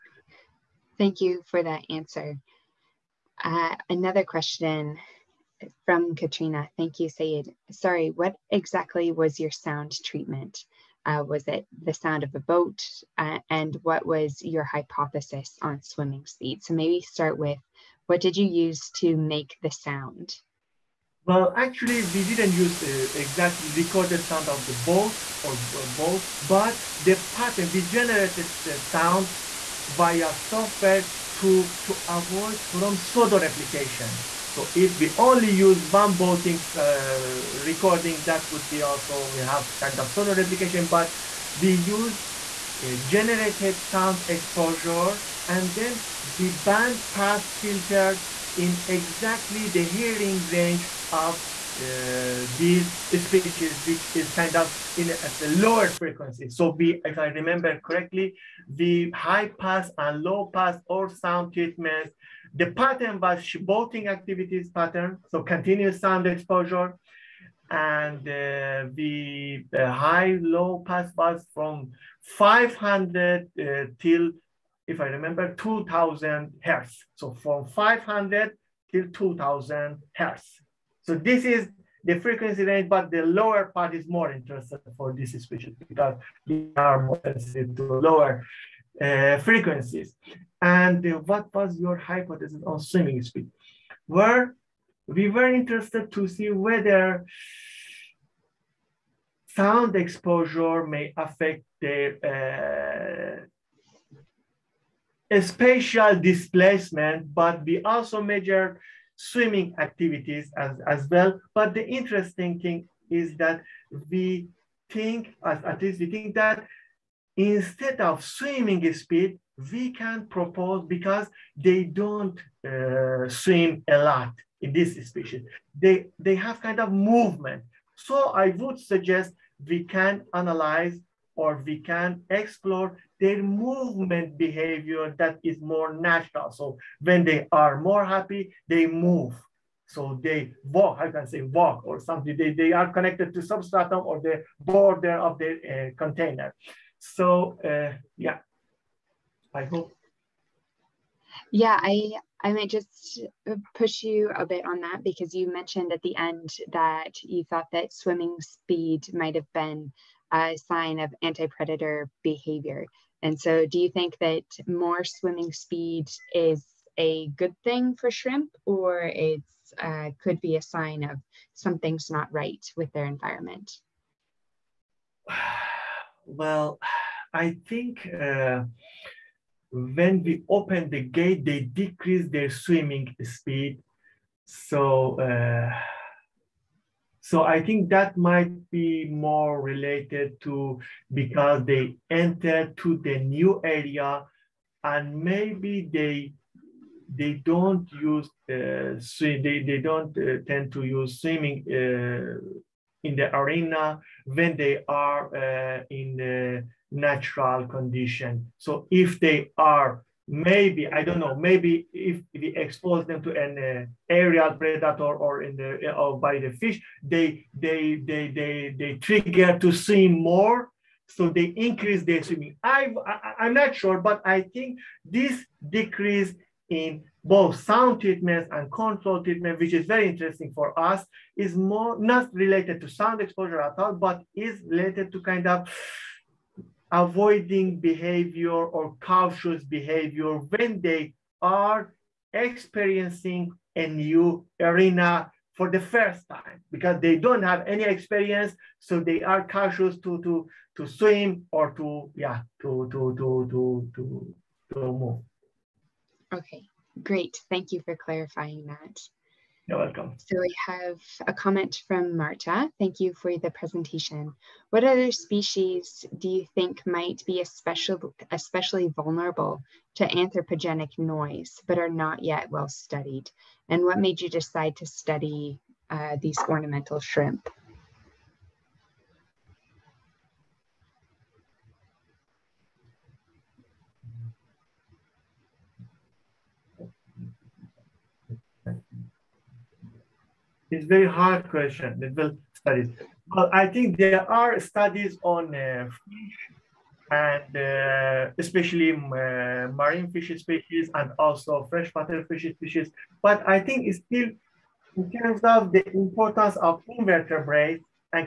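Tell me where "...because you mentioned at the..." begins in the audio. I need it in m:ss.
2:35.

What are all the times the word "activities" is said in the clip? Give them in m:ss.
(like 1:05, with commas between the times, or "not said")
1:04, 1:49.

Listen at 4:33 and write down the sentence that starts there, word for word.
And what made you decide to study uh, these ornamental shrimp?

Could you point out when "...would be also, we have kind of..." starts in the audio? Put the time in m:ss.
0:38.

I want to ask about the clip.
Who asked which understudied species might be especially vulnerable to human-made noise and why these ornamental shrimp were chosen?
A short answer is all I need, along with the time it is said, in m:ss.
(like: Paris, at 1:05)
Marta, at 4:22.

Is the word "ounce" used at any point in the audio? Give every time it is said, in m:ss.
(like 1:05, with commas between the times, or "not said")
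not said.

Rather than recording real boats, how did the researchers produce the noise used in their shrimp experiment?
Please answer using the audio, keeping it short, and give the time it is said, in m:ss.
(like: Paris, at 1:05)
via software, at 0:29.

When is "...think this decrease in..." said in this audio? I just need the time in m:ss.
3:44.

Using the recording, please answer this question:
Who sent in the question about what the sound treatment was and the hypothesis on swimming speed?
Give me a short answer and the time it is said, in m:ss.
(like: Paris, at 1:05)
Katrina, at 0:06.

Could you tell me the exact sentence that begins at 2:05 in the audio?
They, they have kind of movement.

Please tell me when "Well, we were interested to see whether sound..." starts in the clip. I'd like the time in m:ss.
1:34.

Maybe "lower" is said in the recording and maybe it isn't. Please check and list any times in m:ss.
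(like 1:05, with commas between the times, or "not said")
0:55, 1:23, 1:28.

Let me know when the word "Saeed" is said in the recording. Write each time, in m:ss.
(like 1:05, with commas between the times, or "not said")
0:07.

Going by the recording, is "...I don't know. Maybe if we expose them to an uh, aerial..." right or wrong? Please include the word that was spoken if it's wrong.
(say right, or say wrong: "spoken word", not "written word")
right.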